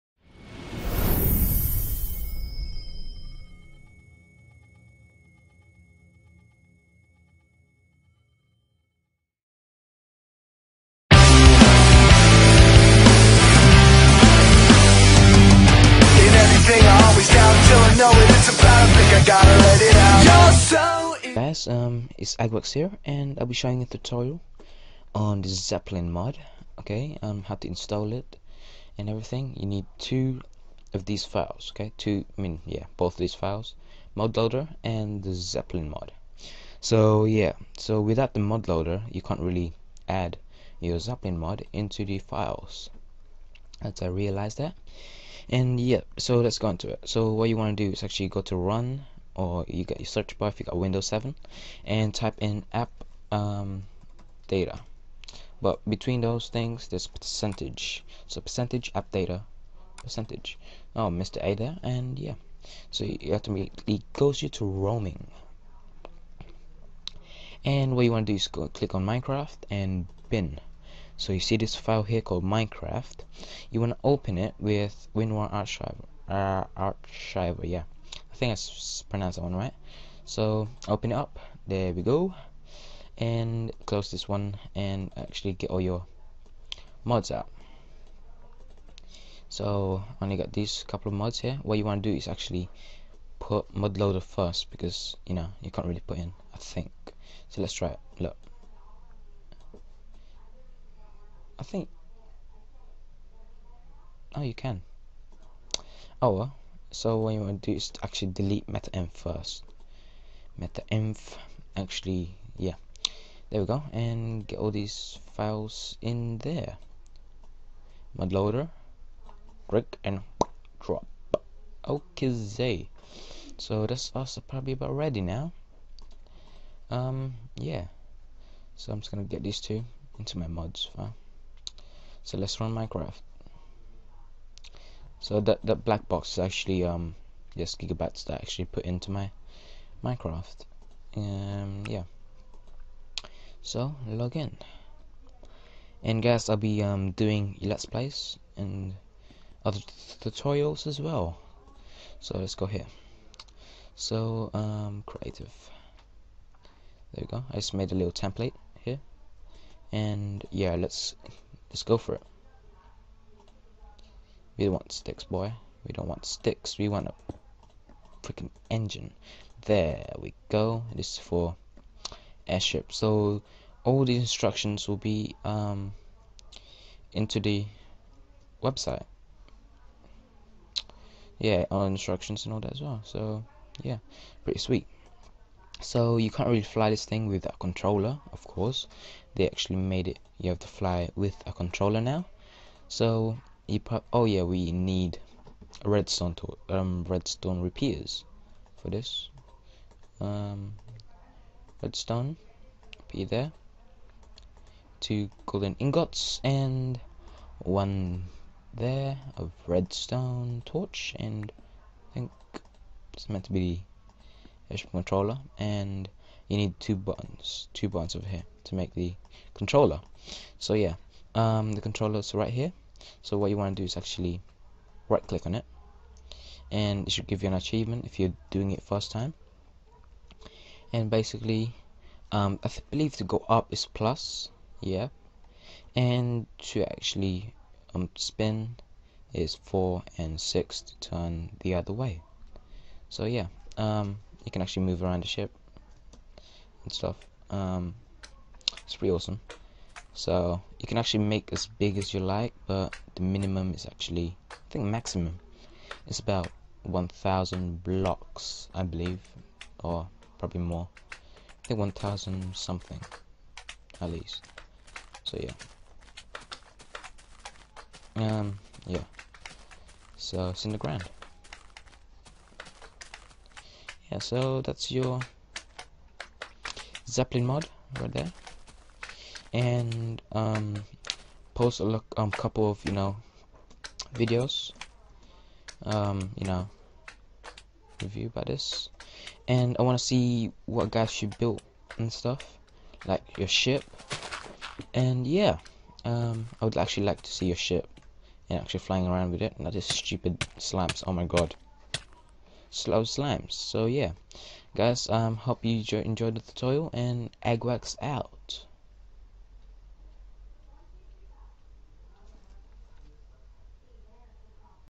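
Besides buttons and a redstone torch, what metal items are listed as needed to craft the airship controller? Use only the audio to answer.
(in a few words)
Two golden ingots.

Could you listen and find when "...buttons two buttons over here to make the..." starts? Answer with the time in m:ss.
3:36.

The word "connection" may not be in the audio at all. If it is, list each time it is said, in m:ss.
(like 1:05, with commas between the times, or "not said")
not said.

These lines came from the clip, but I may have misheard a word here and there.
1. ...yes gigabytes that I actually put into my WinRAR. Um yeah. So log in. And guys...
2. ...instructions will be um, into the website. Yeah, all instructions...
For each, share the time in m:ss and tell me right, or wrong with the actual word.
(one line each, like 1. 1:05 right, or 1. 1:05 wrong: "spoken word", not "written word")
1. 2:17 wrong: "Minecraft", not "WinRAR"
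2. 2:54 right.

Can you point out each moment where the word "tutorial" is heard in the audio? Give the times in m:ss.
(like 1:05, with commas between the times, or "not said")
0:23, 2:30, 5:06.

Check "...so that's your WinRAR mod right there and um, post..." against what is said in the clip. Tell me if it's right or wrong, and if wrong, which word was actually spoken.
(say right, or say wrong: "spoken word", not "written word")
wrong: "Zeppelin", not "WinRAR".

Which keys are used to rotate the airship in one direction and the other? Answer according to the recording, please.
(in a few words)
4 and 6.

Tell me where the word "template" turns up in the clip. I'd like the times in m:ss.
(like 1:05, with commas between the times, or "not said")
2:38.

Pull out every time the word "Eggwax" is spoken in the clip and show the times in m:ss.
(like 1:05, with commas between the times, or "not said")
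5:07.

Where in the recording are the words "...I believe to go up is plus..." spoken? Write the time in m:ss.
3:52.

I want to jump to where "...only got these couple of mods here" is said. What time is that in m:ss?
1:30.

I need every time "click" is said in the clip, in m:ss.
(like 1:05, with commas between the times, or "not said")
1:08, 1:59, 3:45.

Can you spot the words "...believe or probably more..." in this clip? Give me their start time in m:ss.
4:18.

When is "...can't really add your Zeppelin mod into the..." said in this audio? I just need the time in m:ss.
0:39.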